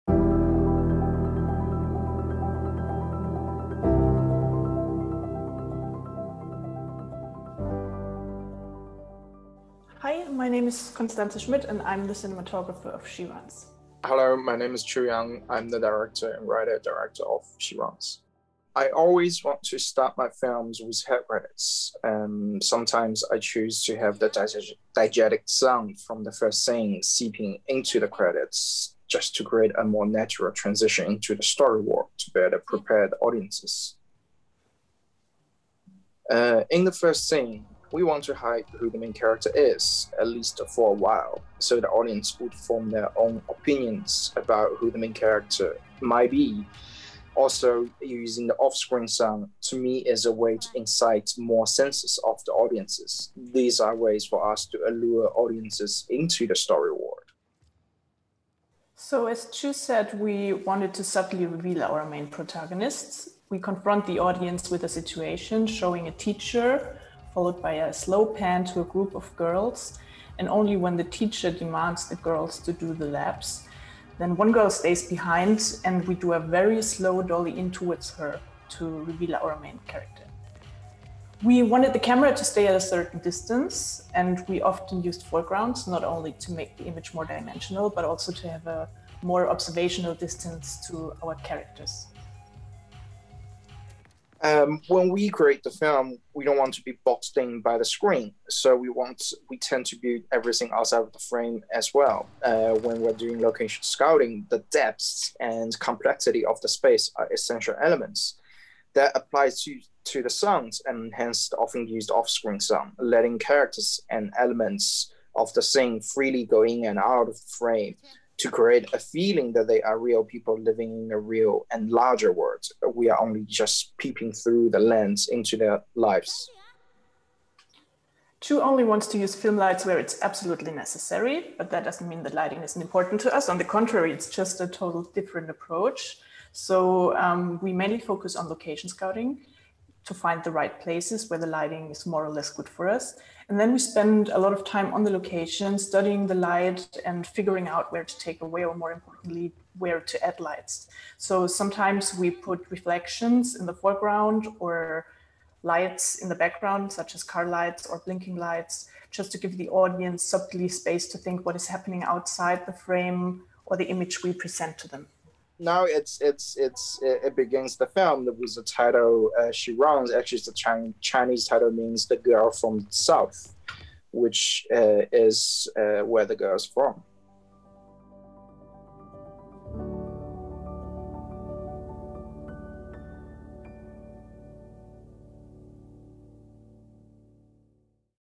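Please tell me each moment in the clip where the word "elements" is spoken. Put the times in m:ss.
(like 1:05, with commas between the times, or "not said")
1:47, 1:54.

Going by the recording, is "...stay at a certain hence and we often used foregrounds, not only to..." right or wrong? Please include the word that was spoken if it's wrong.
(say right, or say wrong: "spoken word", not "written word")
wrong: "distance", not "hence".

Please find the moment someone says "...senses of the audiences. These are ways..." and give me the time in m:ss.
0:51.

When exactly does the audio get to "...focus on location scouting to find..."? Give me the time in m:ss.
2:17.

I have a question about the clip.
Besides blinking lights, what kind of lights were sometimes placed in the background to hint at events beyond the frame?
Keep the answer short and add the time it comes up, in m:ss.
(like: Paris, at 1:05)
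car lights, at 2:37.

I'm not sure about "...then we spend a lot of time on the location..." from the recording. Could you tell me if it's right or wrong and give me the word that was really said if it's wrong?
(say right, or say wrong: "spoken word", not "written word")
right.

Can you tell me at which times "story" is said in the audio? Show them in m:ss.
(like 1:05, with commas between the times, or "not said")
0:31, 0:56.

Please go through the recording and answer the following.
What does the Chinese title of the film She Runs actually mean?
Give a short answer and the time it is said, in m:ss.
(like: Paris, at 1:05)
the girl from the south, at 2:52.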